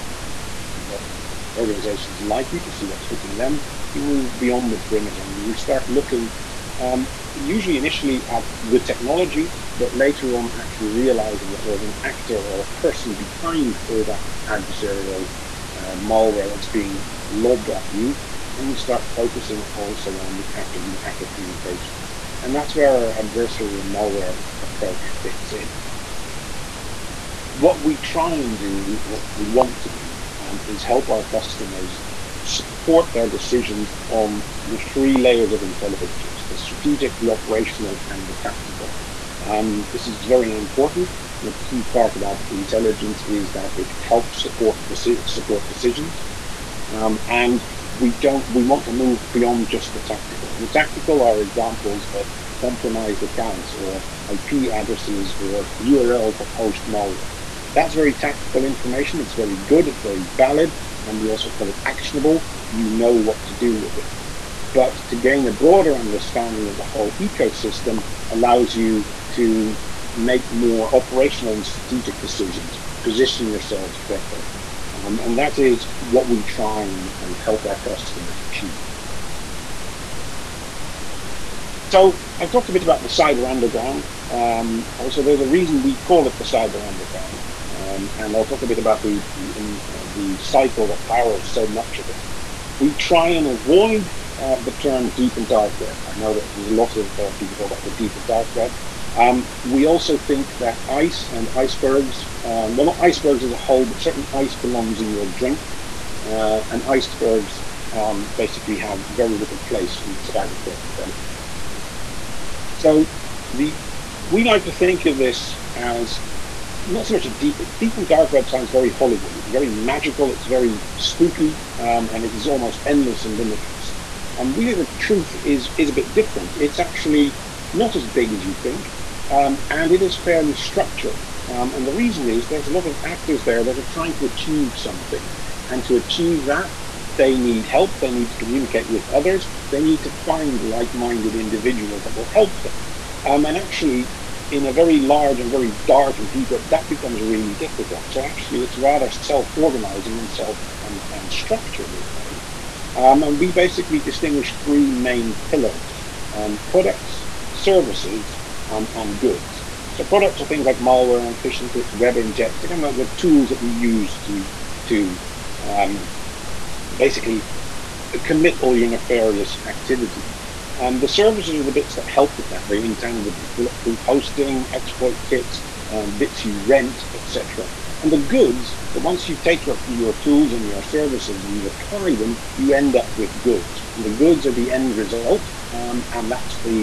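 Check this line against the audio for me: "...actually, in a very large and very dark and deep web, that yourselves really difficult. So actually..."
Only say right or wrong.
wrong.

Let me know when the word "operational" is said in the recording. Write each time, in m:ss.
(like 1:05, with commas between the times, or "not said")
0:37, 1:10.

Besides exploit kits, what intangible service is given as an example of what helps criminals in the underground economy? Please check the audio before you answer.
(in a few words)
Bulletproof hosting.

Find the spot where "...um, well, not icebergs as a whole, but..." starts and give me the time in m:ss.
1:42.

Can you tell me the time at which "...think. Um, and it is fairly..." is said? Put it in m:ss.
2:08.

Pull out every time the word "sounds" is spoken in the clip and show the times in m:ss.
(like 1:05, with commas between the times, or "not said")
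1:58.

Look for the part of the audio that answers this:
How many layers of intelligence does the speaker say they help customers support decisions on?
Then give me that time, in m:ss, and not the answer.
0:34.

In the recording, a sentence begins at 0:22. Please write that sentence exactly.
And that's where our adversary and malware approach fits in.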